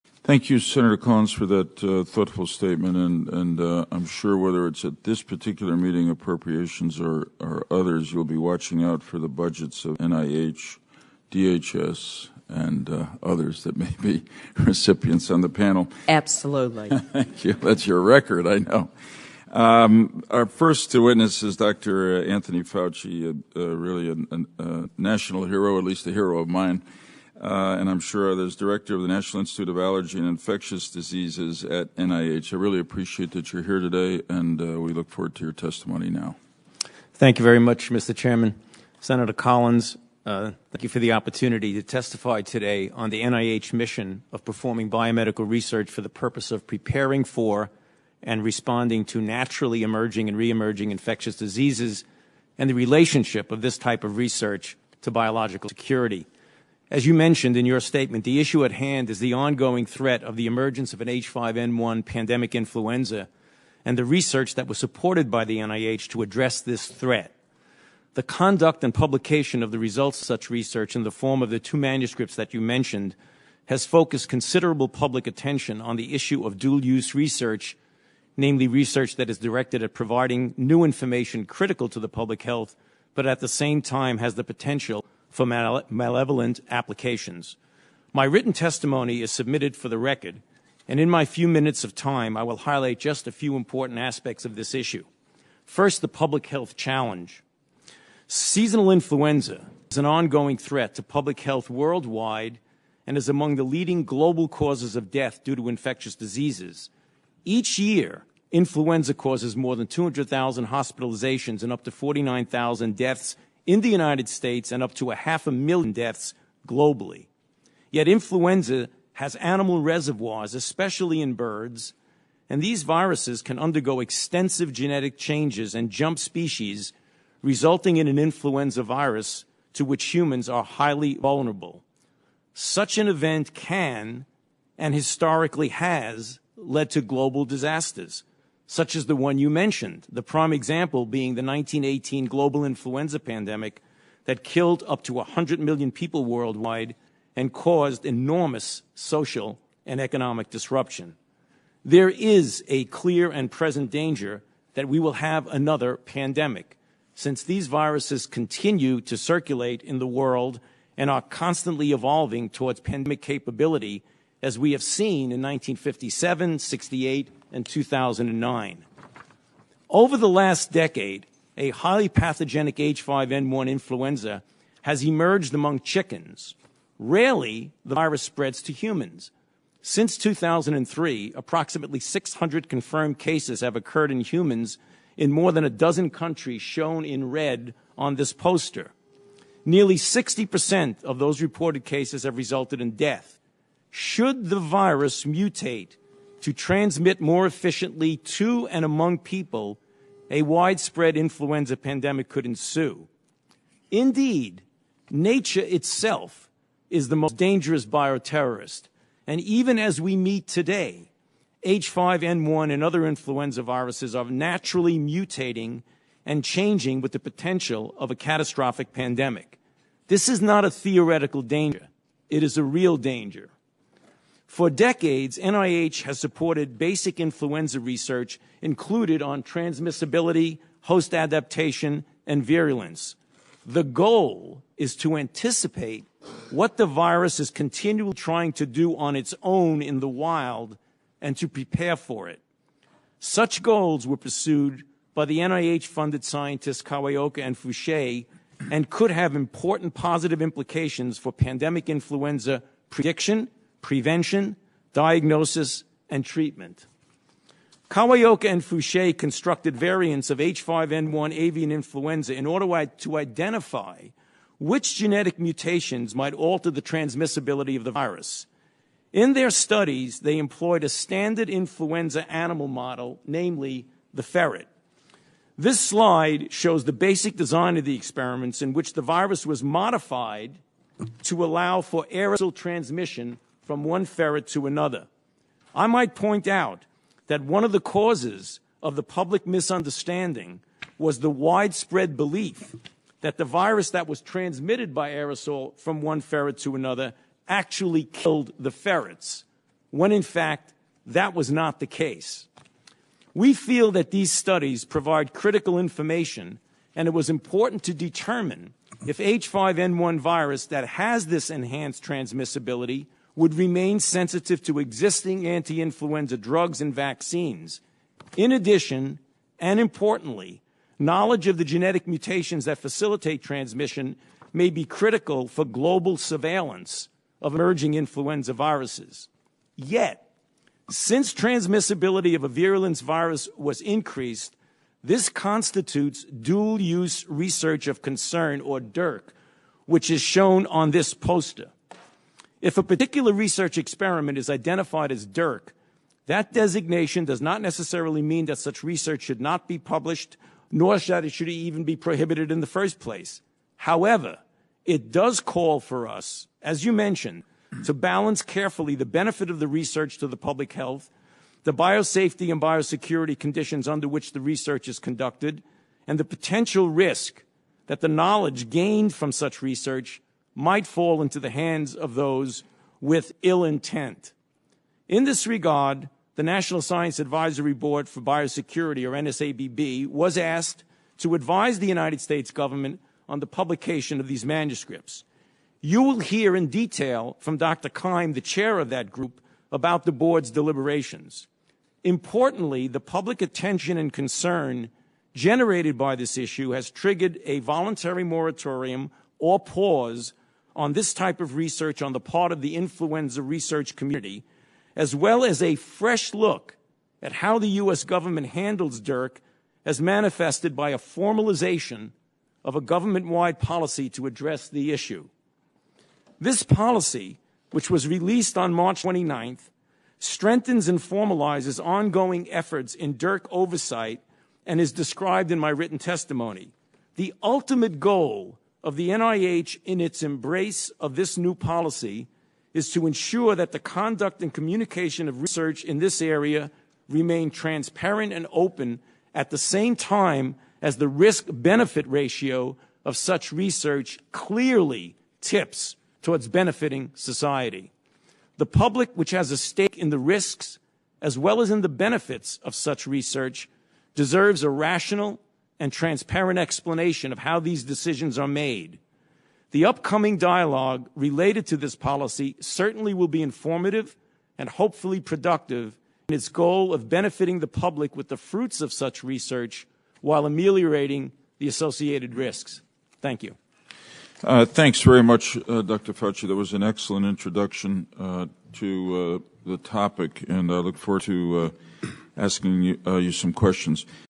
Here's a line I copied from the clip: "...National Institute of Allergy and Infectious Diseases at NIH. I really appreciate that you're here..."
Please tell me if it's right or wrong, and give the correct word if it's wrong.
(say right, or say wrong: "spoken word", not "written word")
right.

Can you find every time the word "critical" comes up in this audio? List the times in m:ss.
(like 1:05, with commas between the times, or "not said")
1:21, 5:05, 5:24.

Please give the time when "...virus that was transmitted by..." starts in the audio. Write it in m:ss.
4:53.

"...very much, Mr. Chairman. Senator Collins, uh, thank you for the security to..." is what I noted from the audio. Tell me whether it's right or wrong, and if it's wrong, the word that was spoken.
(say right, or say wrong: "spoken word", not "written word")
wrong: "opportunity", not "security".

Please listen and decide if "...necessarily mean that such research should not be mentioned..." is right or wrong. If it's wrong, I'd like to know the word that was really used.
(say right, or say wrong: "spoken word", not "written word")
wrong: "published", not "mentioned".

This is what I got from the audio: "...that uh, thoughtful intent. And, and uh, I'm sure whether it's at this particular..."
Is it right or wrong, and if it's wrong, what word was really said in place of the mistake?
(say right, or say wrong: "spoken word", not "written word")
wrong: "statement", not "intent".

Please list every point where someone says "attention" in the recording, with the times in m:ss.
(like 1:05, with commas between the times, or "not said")
1:15, 6:33.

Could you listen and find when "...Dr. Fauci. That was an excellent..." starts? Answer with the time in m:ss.
7:55.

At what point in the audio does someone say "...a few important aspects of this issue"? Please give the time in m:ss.
1:33.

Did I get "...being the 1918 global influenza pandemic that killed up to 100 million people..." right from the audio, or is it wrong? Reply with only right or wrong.
right.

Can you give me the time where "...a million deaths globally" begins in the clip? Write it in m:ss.
1:55.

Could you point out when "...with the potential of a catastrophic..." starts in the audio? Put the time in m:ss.
3:37.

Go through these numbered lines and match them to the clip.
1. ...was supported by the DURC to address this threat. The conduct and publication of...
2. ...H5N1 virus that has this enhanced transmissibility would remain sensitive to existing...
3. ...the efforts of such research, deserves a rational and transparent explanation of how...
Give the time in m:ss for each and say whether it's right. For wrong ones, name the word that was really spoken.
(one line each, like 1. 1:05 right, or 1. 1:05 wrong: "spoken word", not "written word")
1. 1:04 wrong: "NIH", not "DURC"
2. 5:09 right
3. 7:31 wrong: "benefits", not "efforts".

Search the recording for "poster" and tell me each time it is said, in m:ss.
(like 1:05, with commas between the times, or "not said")
3:08, 5:41.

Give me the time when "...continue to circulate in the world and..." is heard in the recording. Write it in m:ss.
2:38.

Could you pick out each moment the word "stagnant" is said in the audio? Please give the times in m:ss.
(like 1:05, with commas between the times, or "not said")
not said.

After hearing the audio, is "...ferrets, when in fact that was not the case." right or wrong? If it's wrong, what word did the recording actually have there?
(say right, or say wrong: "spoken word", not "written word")
right.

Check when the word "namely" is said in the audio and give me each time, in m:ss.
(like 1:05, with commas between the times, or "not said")
1:18, 4:33.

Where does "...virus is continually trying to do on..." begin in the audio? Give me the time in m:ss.
3:56.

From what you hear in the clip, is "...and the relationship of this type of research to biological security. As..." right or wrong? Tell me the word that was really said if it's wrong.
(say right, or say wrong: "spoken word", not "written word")
right.